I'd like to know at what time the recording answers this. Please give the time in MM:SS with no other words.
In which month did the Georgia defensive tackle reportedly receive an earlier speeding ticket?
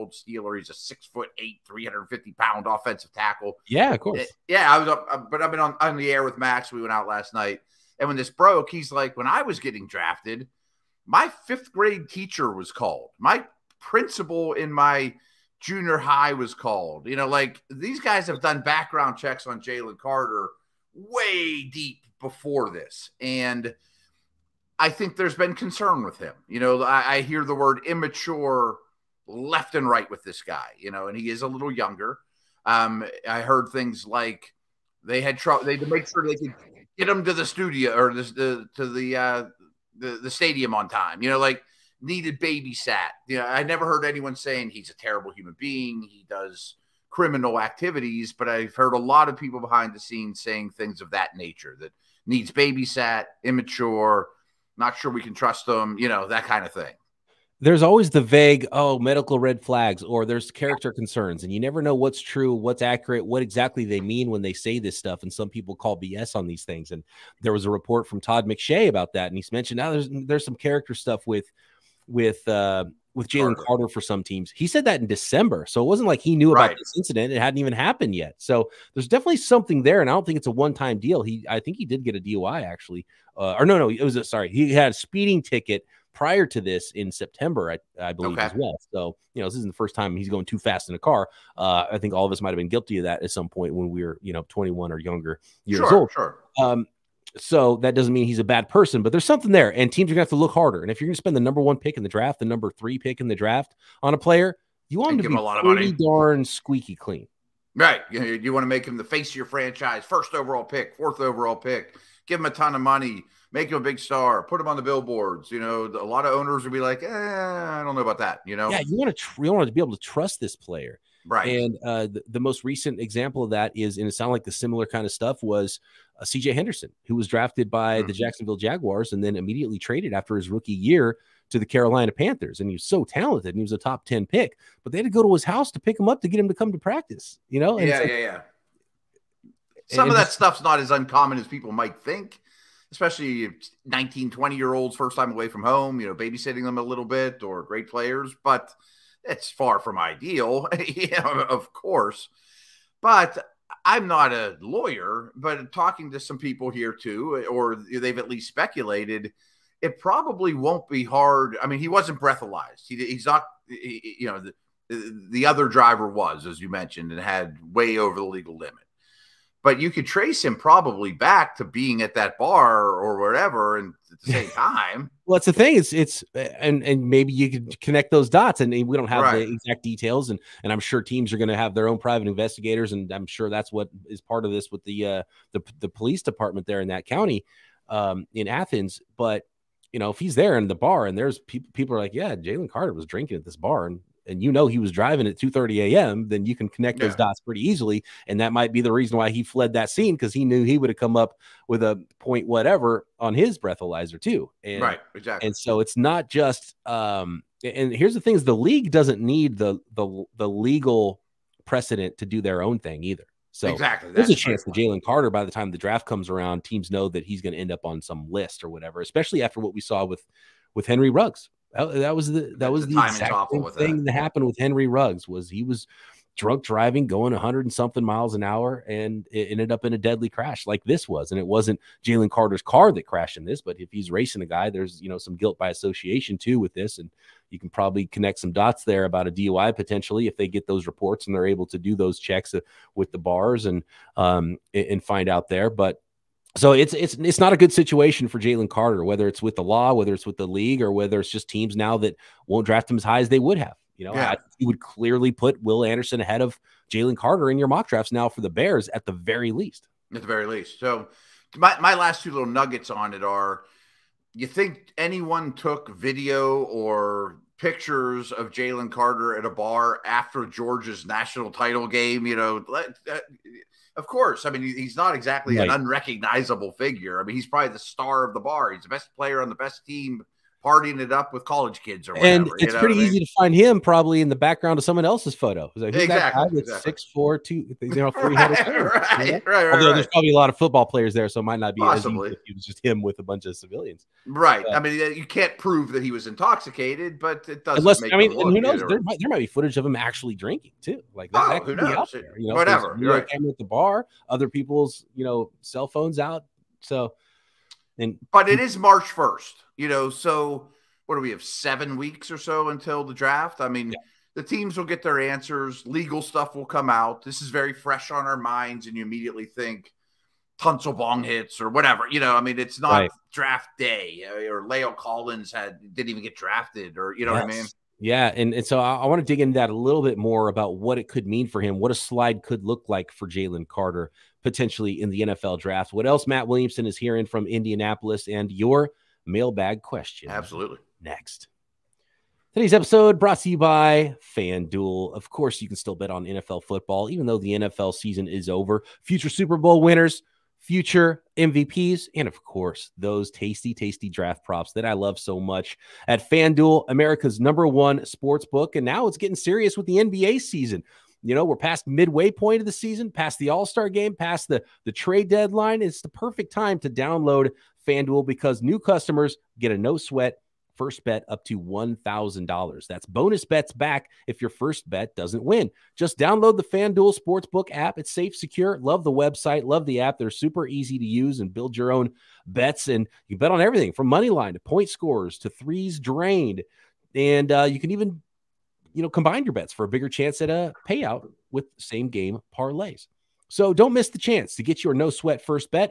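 01:27.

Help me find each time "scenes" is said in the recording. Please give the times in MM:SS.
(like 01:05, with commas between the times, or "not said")
00:49, 03:19.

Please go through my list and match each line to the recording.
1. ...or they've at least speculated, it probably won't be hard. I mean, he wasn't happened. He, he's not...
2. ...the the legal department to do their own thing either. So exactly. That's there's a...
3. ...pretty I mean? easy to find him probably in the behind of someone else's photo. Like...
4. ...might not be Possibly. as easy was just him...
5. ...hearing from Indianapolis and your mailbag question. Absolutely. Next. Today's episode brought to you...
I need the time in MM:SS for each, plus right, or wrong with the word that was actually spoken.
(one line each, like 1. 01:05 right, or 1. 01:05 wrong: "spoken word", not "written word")
1. 02:37 wrong: "breathalyzed", not "happened"
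2. 03:29 wrong: "precedent", not "department"
3. 04:42 wrong: "background", not "behind"
4. 04:51 right
5. 05:36 right.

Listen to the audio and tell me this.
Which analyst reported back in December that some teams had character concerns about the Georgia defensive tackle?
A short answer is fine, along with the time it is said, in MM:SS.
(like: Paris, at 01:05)
Todd McShay, at 01:08.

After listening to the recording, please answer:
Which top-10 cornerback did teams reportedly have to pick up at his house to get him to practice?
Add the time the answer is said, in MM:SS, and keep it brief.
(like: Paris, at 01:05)
CJ Henderson, at 02:06.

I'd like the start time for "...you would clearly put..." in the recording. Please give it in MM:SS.
04:14.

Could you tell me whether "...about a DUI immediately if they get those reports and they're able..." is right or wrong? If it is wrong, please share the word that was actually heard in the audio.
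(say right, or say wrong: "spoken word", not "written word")
wrong: "potentially", not "immediately".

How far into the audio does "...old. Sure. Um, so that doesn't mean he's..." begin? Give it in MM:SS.
01:35.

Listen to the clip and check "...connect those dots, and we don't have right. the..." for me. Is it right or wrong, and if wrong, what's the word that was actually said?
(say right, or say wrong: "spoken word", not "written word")
right.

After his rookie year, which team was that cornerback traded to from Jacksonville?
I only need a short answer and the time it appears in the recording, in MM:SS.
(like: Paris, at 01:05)
Carolina Panthers, at 02:11.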